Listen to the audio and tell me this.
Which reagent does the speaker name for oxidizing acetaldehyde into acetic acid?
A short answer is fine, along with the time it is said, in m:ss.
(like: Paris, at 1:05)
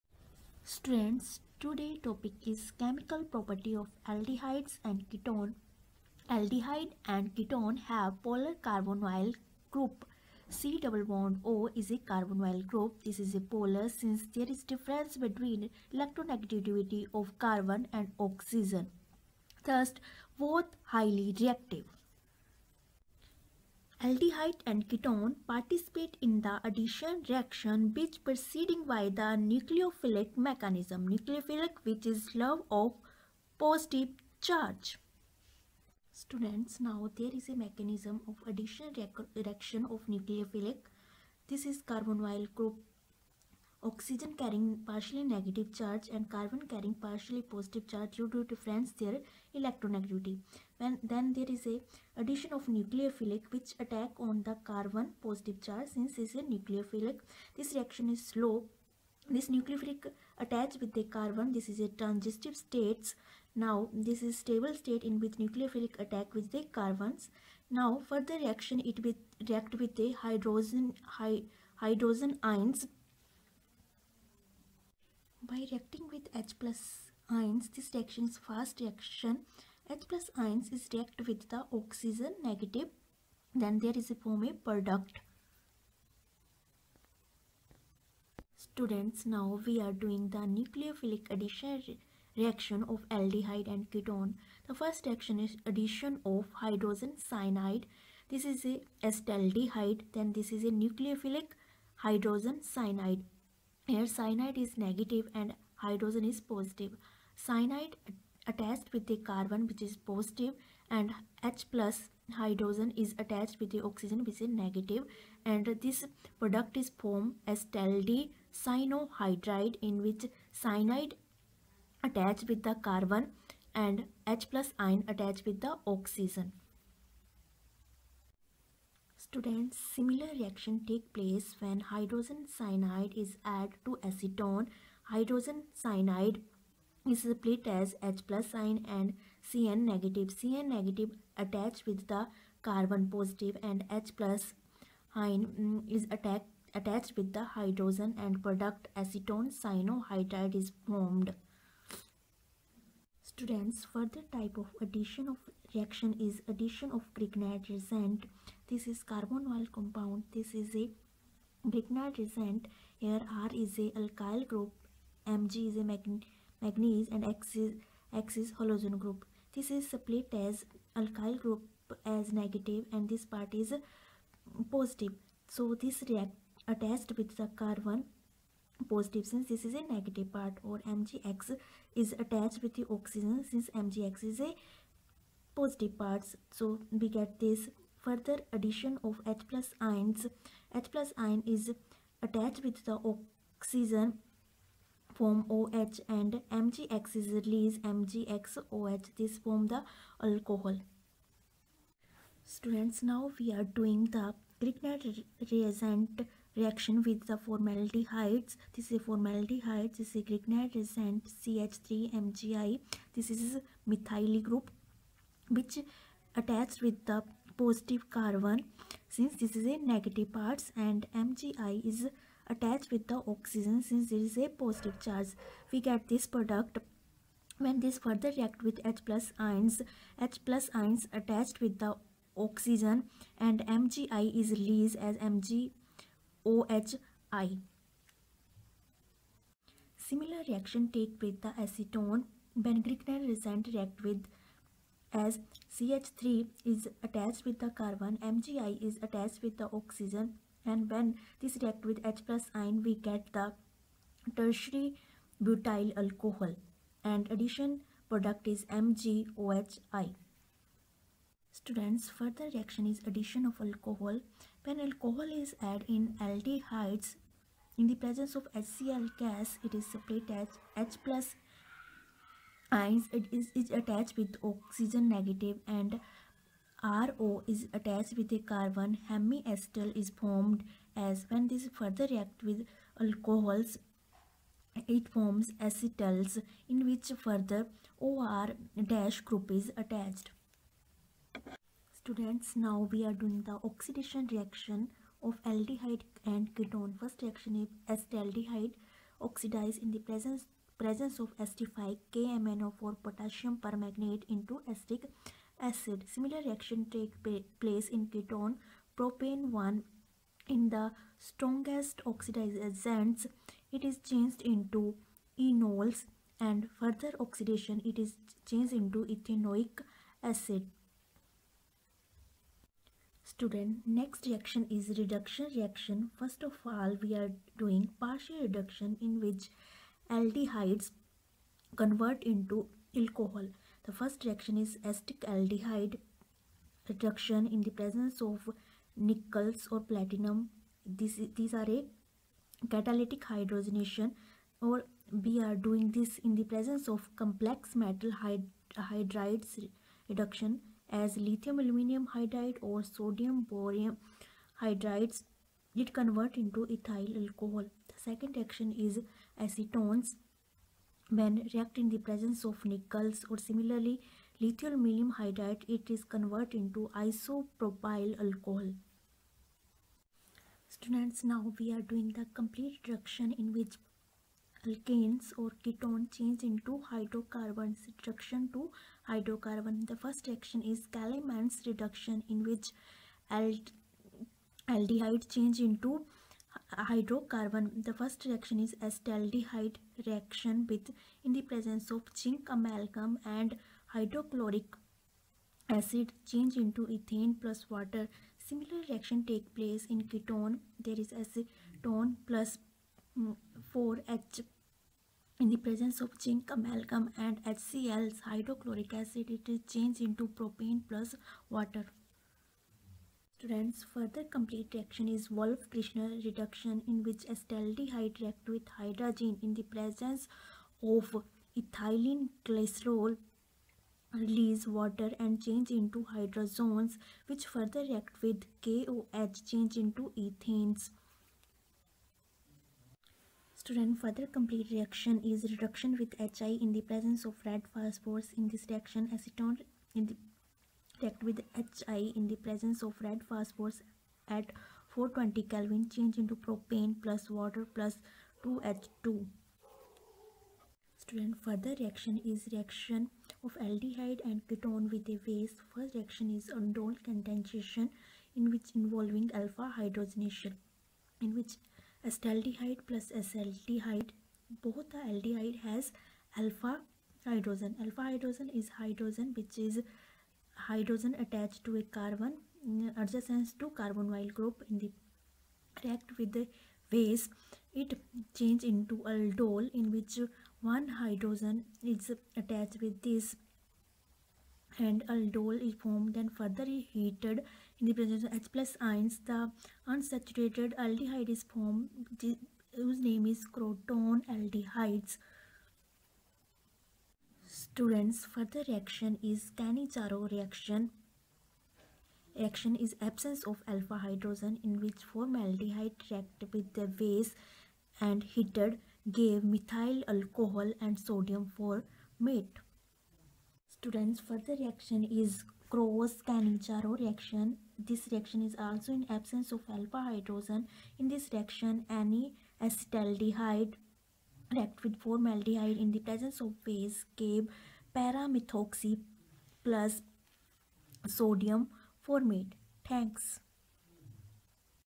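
potassium permanganate, at 5:03.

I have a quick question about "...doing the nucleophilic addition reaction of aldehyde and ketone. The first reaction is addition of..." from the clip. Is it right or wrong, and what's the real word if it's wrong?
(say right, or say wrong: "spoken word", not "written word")
right.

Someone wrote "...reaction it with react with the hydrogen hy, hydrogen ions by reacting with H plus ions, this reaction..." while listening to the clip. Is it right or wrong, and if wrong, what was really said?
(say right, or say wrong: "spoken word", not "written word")
right.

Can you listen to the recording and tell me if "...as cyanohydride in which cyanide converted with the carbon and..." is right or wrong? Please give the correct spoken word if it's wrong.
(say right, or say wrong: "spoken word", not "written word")
wrong: "attached", not "converted".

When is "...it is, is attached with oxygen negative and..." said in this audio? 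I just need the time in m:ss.
4:33.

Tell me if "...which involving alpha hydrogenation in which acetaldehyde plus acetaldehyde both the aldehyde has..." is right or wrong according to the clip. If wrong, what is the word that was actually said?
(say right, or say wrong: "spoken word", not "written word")
right.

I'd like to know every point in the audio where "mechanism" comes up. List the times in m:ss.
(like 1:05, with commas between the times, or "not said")
0:30, 0:37.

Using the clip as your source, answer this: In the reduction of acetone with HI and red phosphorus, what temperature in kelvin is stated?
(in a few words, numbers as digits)
420 Kelvin.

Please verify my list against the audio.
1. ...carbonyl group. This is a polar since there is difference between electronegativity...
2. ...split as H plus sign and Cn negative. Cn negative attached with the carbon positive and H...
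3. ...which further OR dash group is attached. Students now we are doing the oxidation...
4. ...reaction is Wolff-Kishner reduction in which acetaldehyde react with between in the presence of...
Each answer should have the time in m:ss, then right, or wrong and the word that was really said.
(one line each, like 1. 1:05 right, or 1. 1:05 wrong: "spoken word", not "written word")
1. 0:12 right
2. 2:17 right
3. 4:46 right
4. 6:54 wrong: "hydrogen", not "between".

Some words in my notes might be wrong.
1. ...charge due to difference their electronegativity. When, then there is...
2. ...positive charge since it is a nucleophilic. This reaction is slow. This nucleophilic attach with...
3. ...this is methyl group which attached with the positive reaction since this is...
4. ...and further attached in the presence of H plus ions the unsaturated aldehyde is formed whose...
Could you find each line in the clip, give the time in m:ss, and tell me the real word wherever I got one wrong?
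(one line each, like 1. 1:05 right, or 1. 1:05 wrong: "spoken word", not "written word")
1. 0:47 right
2. 0:55 right
3. 3:33 wrong: "carbon", not "reaction"
4. 8:06 wrong: "heated", not "attached".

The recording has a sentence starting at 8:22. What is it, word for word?
Reaction is absence of alpha hydrogen in which formaldehyde reacted with the base and heated gave methyl alcohol and sodium for mate.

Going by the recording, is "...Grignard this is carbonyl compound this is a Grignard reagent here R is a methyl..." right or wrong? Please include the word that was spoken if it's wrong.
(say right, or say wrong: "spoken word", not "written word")
wrong: "alkyl", not "methyl".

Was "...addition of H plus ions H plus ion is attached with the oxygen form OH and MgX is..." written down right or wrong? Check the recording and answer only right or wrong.
right.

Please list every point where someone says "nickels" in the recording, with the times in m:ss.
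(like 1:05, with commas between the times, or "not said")
5:38, 6:02.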